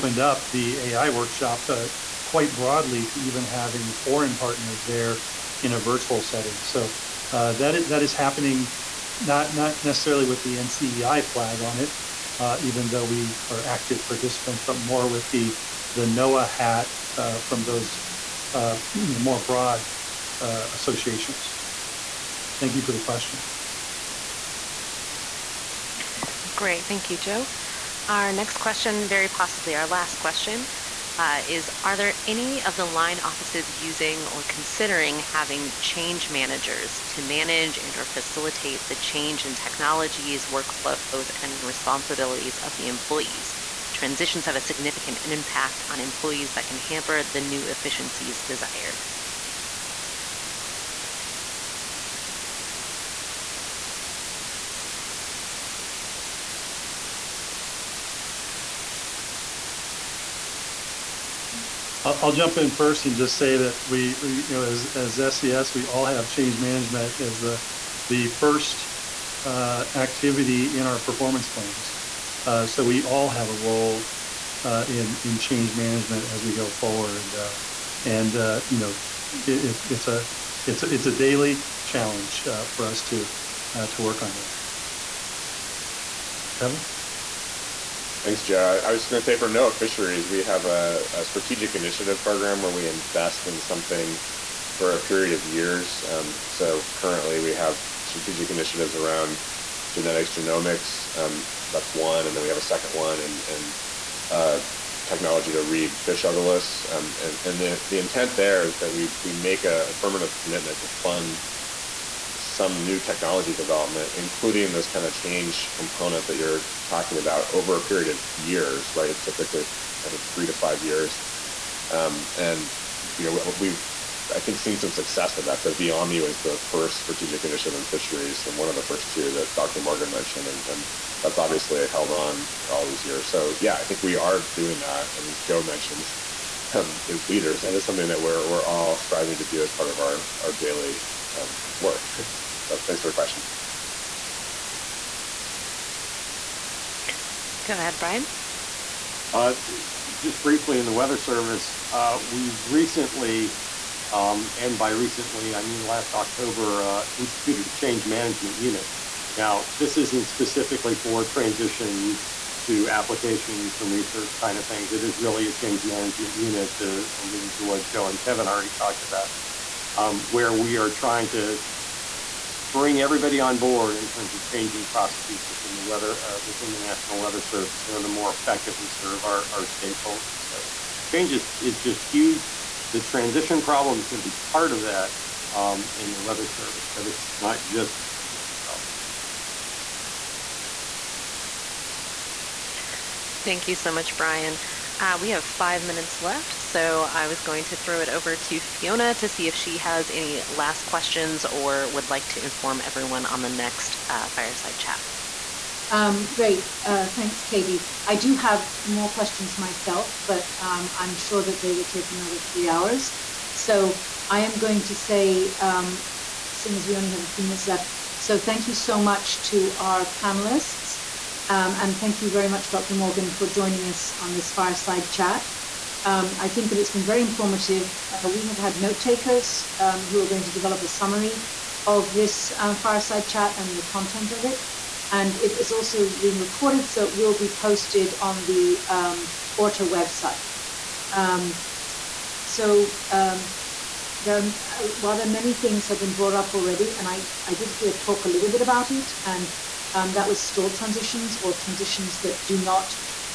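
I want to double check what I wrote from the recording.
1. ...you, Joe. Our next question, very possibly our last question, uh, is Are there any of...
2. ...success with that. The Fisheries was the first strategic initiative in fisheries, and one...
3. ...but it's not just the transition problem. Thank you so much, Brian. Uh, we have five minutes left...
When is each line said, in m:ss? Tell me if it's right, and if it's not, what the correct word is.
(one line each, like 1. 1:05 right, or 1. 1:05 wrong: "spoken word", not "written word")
1. 0:27 right
2. 2:04 wrong: "Viame", not "Fisheries"
3. 3:06 right.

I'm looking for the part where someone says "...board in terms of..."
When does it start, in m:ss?
2:53.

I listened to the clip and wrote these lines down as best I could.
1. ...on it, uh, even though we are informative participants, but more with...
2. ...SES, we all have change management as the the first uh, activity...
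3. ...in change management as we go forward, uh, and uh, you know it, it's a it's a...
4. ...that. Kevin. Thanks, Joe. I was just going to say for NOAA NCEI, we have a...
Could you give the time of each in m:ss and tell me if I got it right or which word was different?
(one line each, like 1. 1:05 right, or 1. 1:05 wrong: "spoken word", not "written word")
1. 0:11 wrong: "active", not "informative"
2. 1:05 right
3. 1:15 right
4. 1:24 wrong: "Fisheries", not "NCEI".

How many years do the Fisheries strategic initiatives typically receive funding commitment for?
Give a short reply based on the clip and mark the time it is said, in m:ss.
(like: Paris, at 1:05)
3 to 5 years, at 2:00.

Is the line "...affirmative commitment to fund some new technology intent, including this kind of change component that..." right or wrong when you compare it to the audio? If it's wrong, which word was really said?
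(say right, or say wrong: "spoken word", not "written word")
wrong: "development", not "intent".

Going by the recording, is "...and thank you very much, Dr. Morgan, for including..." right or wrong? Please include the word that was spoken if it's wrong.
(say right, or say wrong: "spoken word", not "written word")
wrong: "joining", not "including".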